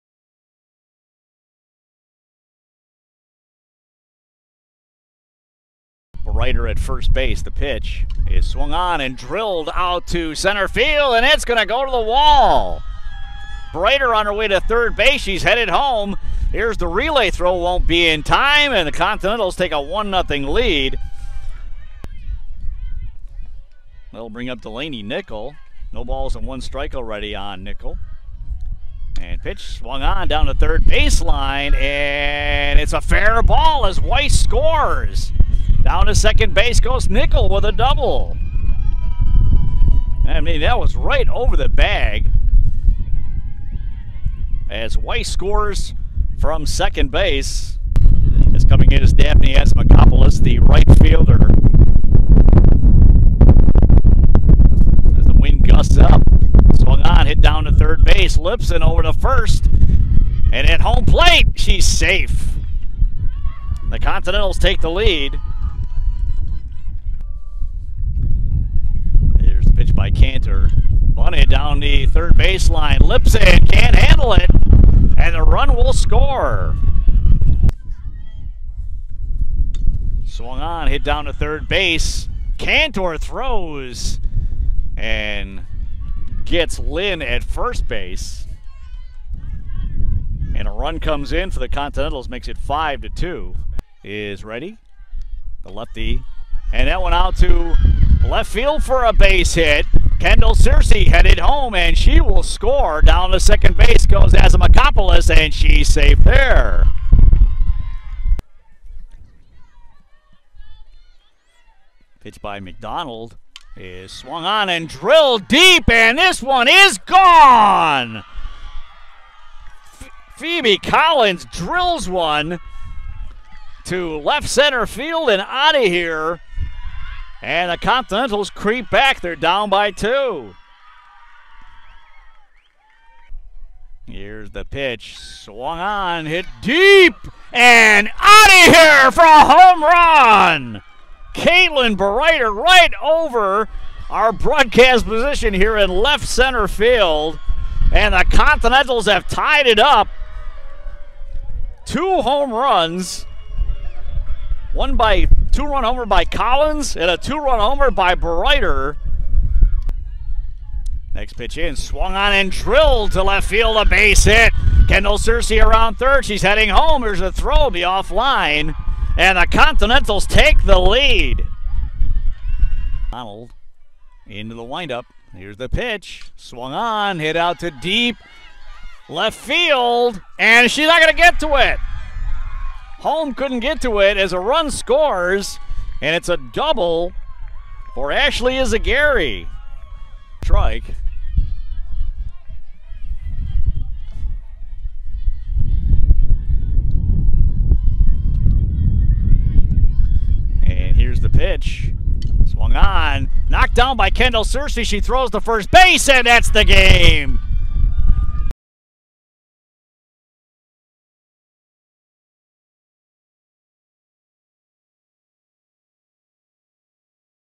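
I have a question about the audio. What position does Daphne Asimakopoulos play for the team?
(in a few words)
Right fielder.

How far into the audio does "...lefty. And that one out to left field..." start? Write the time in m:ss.
1:35.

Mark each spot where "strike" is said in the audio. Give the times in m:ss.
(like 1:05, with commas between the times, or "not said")
0:26, 3:10.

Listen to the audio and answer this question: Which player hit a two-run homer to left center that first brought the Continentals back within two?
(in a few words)
Phoebe Collins.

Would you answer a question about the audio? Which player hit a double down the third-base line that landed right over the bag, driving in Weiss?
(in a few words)
Delaney Nickel.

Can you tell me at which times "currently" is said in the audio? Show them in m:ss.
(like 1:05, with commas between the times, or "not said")
not said.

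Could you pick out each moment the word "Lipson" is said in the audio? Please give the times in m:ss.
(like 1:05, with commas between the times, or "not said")
0:58, 1:13.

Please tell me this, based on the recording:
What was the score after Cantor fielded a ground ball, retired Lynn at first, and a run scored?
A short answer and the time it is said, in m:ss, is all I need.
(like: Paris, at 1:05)
5 to 2, at 1:32.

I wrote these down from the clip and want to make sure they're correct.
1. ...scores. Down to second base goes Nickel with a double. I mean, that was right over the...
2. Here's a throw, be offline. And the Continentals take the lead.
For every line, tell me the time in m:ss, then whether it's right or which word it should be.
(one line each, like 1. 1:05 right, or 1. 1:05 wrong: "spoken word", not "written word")
1. 0:34 right
2. 2:47 right.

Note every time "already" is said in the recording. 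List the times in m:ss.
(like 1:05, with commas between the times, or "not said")
0:26.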